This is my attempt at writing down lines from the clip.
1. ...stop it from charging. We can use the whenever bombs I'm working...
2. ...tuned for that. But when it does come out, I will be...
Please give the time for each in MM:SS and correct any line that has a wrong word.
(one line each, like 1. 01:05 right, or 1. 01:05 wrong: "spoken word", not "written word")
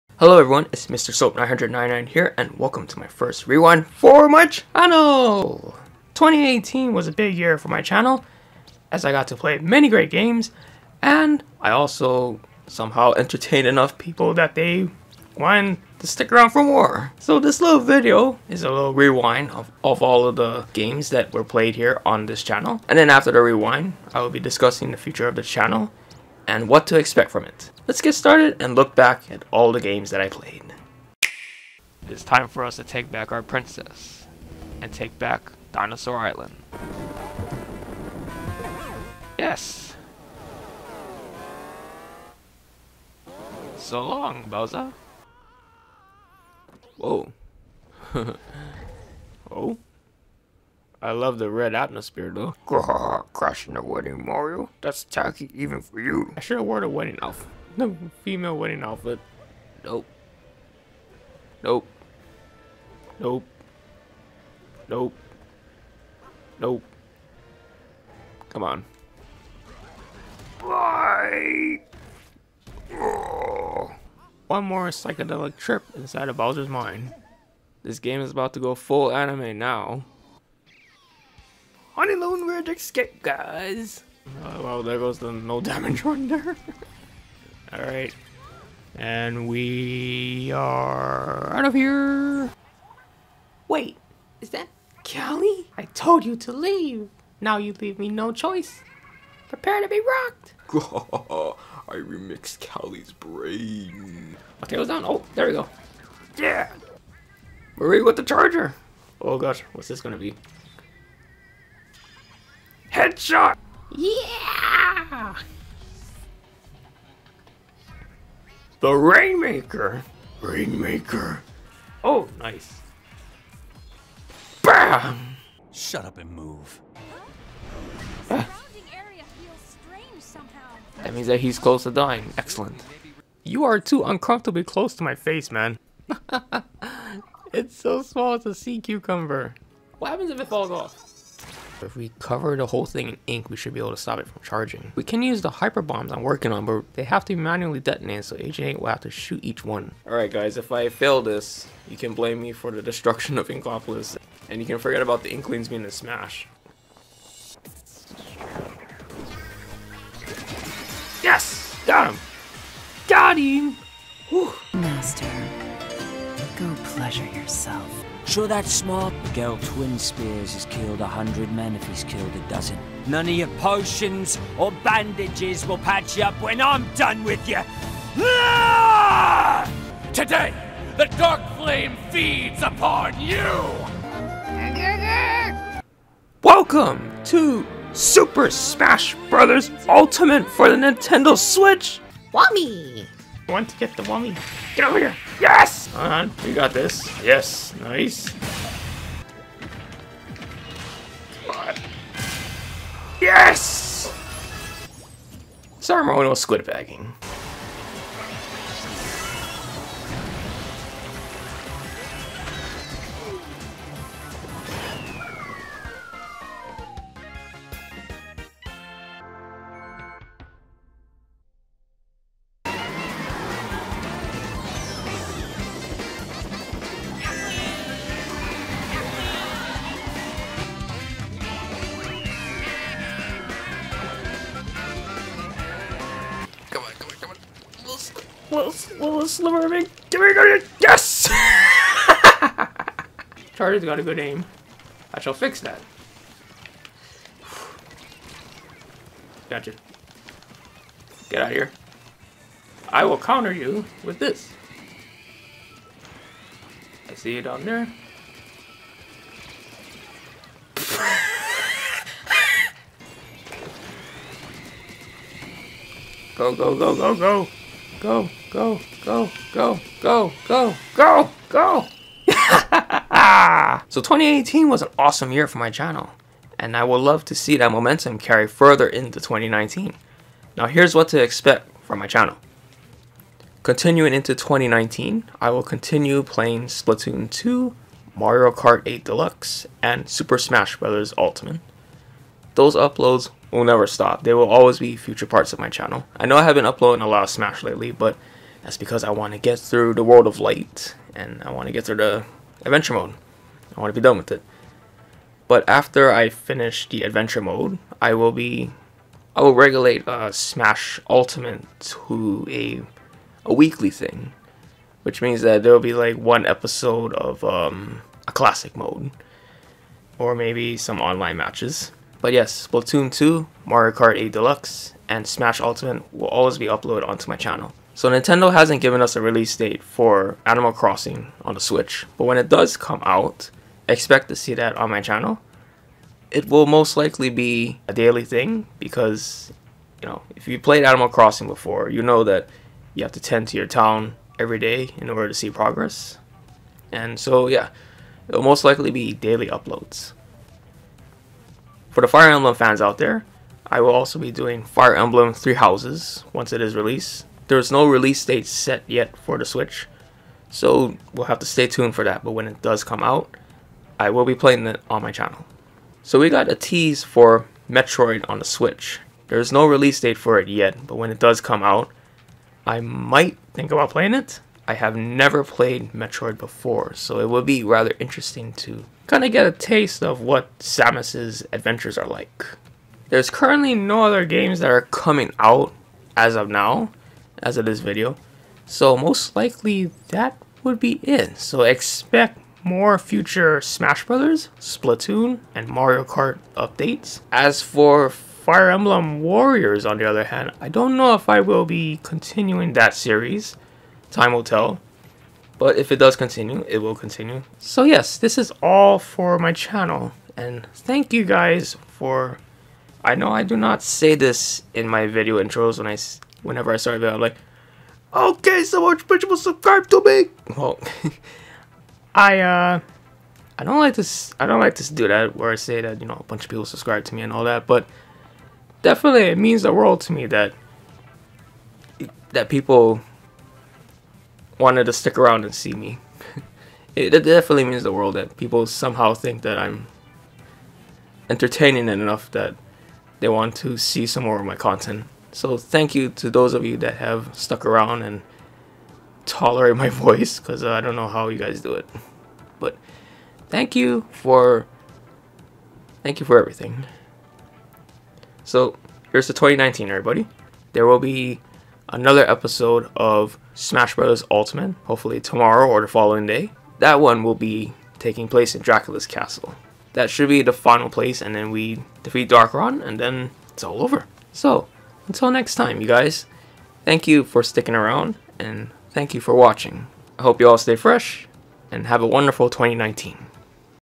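1. 02:23 wrong: "hyper", not "whenever"
2. 06:01 right.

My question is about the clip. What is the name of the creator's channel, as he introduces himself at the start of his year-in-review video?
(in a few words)
Mr. Soap999.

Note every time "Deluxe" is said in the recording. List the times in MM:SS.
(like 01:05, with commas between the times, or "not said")
04:49, 05:24.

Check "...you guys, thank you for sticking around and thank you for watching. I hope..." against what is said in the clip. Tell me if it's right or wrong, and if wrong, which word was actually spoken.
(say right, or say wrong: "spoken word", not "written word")
right.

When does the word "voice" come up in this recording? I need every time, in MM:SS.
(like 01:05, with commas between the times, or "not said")
07:29.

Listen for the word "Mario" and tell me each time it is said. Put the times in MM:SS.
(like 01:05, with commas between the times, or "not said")
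00:54, 04:48, 05:23, 06:35.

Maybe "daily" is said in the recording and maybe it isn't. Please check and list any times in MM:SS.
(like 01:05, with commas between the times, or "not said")
05:37, 05:49.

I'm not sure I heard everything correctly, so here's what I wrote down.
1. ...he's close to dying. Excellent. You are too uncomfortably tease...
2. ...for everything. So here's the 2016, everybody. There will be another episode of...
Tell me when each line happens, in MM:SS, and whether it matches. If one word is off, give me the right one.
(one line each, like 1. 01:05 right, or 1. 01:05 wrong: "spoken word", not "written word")
1. 02:11 wrong: "close", not "tease"
2. 07:36 wrong: "2019", not "2016".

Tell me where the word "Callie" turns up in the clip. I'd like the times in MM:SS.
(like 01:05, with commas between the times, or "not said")
01:35, 01:42.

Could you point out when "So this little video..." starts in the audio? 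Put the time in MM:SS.
00:17.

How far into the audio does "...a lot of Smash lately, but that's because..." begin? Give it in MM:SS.
04:57.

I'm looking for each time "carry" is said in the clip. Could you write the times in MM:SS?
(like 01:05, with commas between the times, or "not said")
04:38.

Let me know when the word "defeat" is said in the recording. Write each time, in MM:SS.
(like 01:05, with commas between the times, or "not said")
07:52.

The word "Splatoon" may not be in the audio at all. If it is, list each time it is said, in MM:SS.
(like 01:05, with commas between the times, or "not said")
04:46, 05:22, 06:34.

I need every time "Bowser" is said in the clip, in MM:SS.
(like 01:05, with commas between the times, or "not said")
00:44, 01:16.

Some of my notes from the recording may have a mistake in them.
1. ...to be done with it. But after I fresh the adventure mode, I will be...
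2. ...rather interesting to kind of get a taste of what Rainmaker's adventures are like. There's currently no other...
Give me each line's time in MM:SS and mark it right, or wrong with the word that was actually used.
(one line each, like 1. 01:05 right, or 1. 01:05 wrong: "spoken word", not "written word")
1. 05:03 wrong: "finish", not "fresh"
2. 06:17 wrong: "Samus", not "Rainmaker".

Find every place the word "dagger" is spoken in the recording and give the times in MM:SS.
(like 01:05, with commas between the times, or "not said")
not said.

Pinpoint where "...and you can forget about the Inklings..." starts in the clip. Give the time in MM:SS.
02:34.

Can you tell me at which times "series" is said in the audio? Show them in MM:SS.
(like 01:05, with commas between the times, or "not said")
06:42.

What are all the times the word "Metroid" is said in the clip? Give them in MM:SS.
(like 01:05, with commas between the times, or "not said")
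06:07, 06:15.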